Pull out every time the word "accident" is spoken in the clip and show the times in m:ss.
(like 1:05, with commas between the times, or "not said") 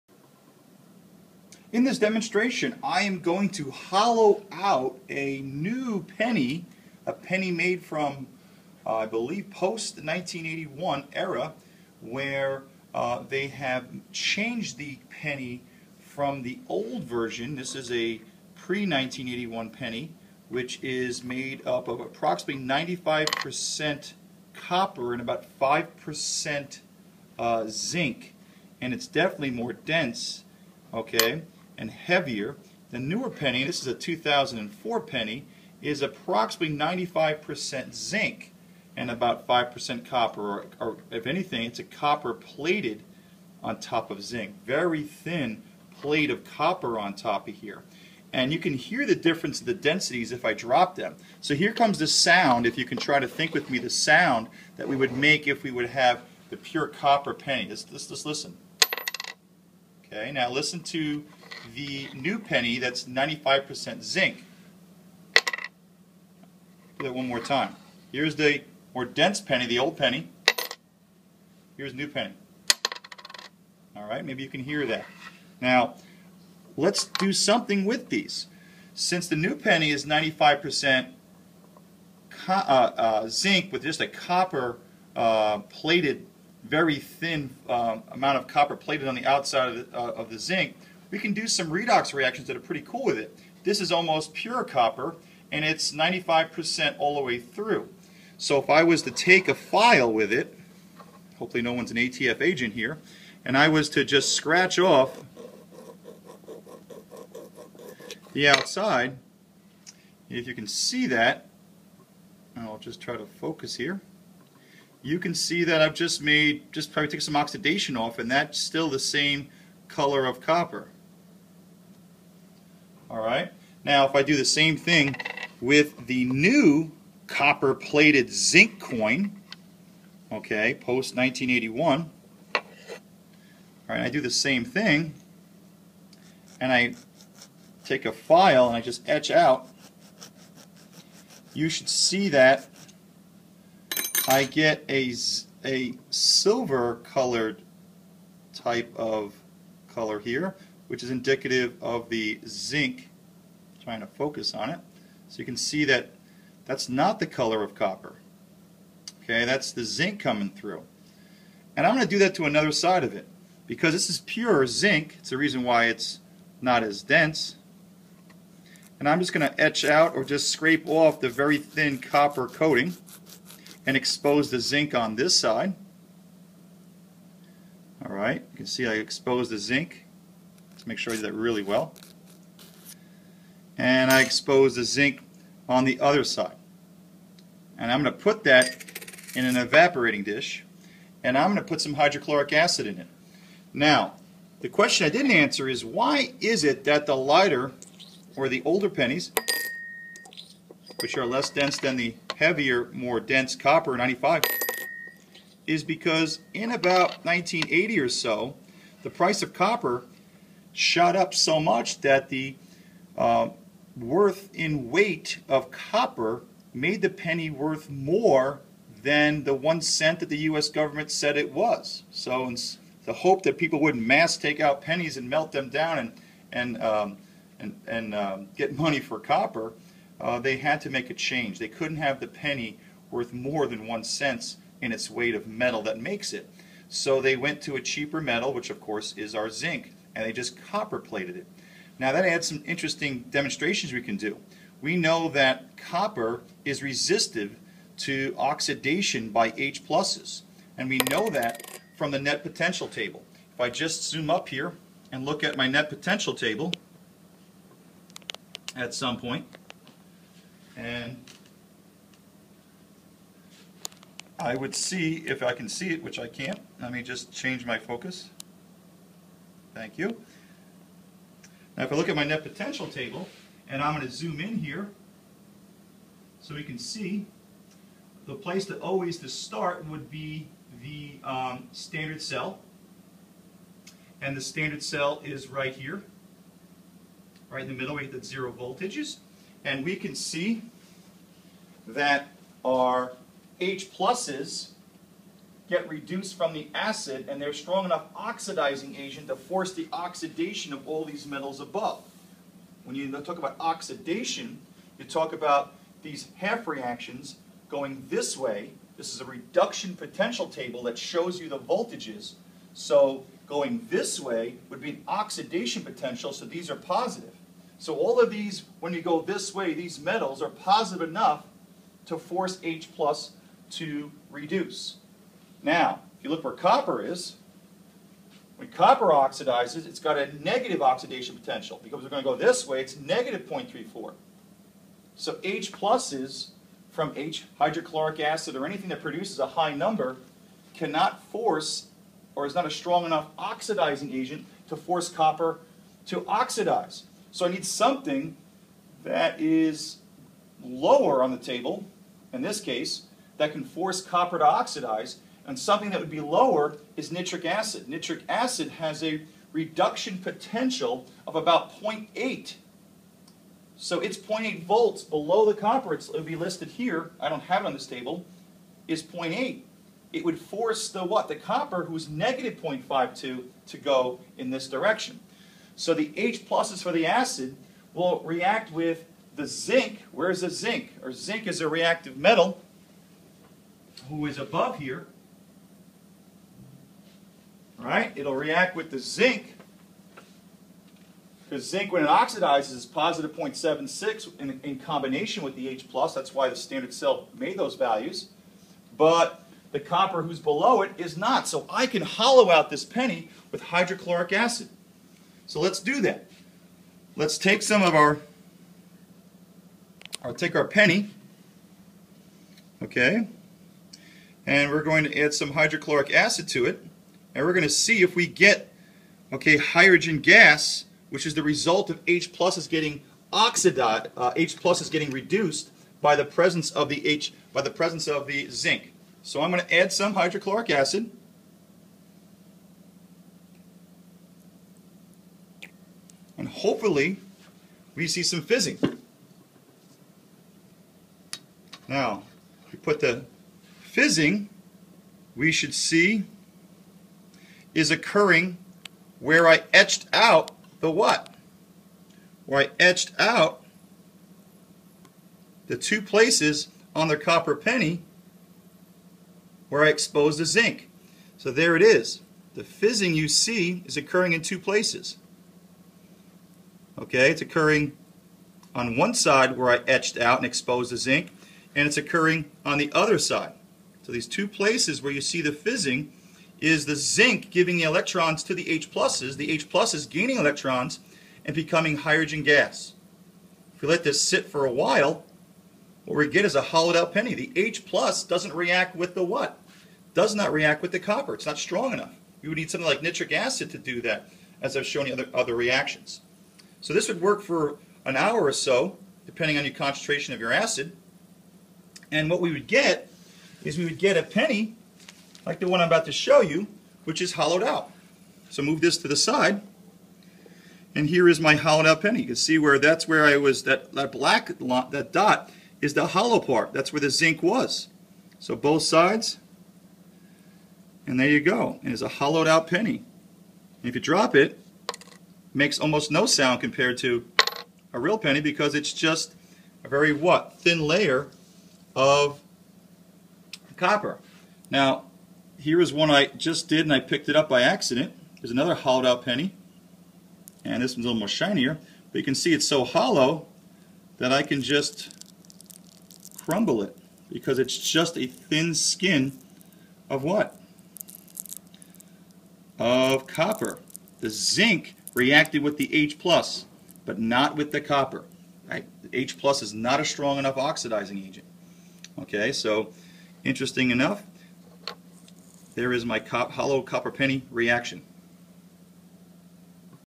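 8:57.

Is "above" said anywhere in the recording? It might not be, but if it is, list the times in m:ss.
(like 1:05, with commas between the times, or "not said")
5:01, 6:24.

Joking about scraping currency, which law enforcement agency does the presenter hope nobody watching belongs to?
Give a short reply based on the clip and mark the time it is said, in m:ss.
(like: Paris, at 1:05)
ATF, at 1:41.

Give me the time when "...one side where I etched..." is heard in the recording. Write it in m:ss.
7:48.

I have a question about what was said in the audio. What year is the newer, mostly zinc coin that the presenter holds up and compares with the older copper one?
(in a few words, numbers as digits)
2004.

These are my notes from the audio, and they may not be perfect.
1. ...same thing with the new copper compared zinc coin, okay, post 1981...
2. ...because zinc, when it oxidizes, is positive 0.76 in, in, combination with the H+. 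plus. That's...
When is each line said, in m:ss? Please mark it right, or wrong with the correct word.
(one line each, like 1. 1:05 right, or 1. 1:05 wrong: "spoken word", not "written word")
1. 2:04 wrong: "plated", not "compared"
2. 6:31 right.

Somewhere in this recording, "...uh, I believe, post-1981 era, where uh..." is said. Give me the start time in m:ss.
0:08.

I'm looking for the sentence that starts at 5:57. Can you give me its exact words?
Nitric acid has a reduction potential of about 0.8.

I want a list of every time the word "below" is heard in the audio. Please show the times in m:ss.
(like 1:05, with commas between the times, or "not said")
6:05, 6:40.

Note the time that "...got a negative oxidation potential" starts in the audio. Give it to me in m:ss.
5:29.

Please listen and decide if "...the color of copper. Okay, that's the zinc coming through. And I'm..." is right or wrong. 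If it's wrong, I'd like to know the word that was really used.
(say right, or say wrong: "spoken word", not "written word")
right.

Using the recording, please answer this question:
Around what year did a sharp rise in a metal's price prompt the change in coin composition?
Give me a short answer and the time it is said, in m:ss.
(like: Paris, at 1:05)
1980, at 3:27.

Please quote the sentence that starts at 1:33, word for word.
This is almost pure copper, and it's 95% all the way through.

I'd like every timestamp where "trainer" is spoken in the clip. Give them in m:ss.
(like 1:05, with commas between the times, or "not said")
not said.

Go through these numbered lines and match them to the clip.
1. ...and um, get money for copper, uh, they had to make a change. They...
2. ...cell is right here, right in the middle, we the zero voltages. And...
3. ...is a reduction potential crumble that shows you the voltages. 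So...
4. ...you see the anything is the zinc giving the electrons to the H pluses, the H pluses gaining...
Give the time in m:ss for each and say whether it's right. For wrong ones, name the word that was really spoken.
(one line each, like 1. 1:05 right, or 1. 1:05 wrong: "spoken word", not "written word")
1. 3:47 right
2. 4:44 right
3. 5:09 wrong: "table", not "crumble"
4. 7:55 wrong: "fizzing", not "anything".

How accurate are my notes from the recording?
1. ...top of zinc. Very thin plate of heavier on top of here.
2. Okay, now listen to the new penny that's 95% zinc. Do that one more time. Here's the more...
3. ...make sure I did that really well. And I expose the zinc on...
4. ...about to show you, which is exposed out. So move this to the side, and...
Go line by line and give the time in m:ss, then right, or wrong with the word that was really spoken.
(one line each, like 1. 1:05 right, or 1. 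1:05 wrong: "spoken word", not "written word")
1. 0:43 wrong: "copper", not "heavier"
2. 1:00 right
3. 3:00 right
4. 8:25 wrong: "hollowed", not "exposed".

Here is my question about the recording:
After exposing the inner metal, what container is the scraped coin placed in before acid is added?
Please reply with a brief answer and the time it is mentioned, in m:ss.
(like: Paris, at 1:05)
an evaporating dish, at 3:09.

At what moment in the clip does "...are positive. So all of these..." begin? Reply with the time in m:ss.
5:16.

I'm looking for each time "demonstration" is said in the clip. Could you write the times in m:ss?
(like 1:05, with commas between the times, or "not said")
0:01, 4:03.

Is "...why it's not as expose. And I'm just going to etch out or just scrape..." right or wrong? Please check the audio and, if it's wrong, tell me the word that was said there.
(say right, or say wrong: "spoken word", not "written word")
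wrong: "dense", not "expose".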